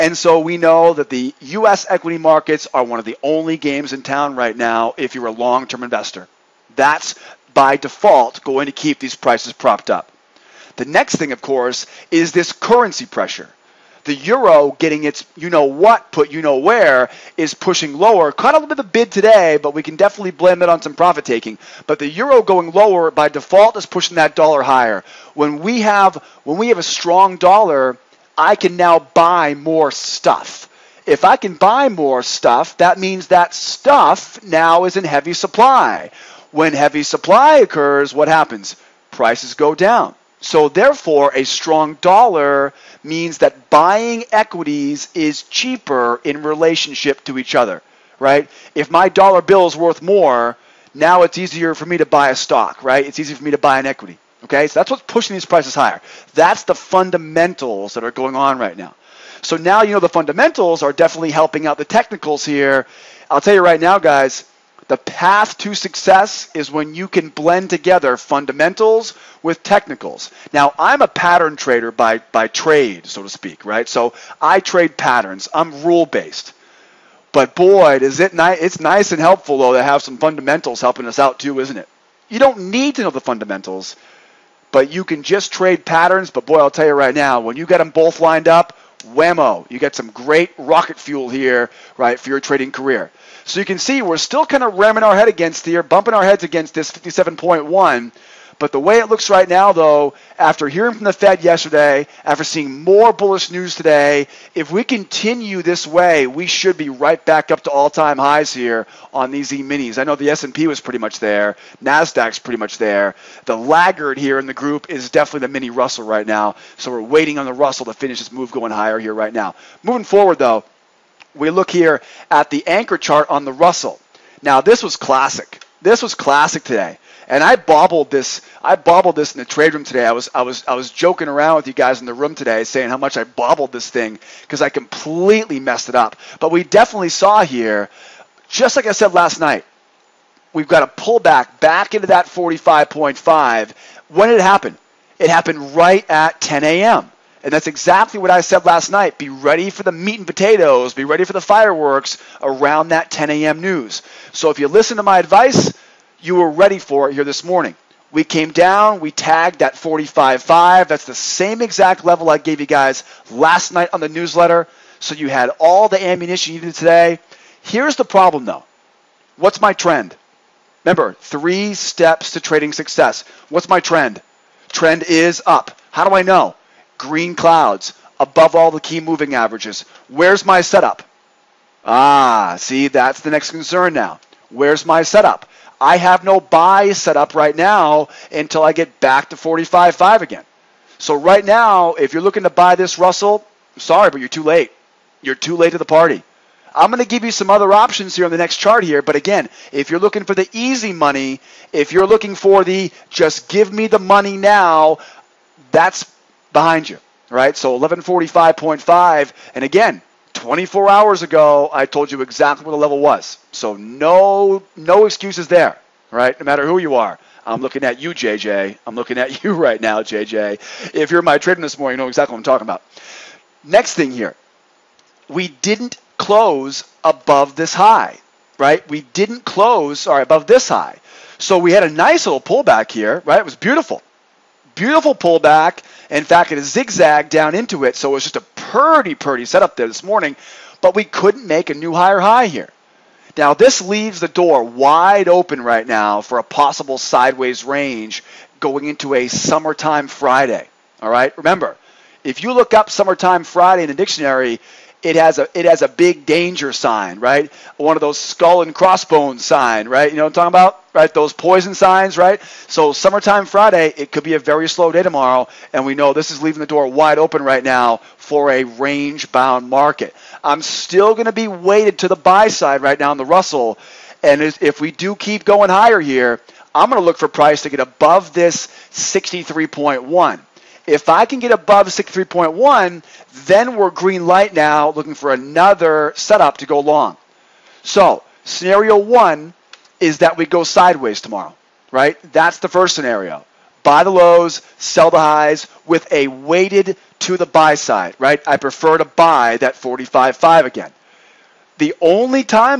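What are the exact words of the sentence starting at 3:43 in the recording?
Next thing here, we didn't close above this high, right?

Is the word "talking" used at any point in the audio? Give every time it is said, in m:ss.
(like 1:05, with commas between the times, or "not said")
3:42, 4:20.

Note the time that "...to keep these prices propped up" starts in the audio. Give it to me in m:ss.
0:08.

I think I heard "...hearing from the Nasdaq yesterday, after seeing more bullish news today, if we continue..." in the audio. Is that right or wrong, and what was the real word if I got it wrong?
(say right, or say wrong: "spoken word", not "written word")
wrong: "Fed", not "Nasdaq".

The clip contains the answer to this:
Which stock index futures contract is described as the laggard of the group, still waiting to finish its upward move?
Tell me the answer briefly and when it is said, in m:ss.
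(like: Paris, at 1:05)
mini Russell, at 1:55.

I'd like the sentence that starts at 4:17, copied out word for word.
One of those skull and crossbones sign, right?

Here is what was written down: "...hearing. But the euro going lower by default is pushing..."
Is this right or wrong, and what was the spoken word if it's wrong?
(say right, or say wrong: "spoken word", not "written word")
wrong: "taking", not "hearing".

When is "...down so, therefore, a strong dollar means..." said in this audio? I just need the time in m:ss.
0:39.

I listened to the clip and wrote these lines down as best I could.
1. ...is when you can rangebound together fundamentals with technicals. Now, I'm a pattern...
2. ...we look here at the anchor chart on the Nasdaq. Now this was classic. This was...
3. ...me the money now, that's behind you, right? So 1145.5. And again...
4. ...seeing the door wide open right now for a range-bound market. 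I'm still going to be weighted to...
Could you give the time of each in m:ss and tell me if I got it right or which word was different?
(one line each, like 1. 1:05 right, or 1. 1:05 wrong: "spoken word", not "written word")
1. 1:06 wrong: "blend", not "rangebound"
2. 2:01 wrong: "Russell", not "Nasdaq"
3. 3:23 right
4. 4:26 wrong: "leaving", not "seeing".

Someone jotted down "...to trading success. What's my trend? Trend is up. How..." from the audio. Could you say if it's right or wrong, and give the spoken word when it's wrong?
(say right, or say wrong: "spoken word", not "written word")
right.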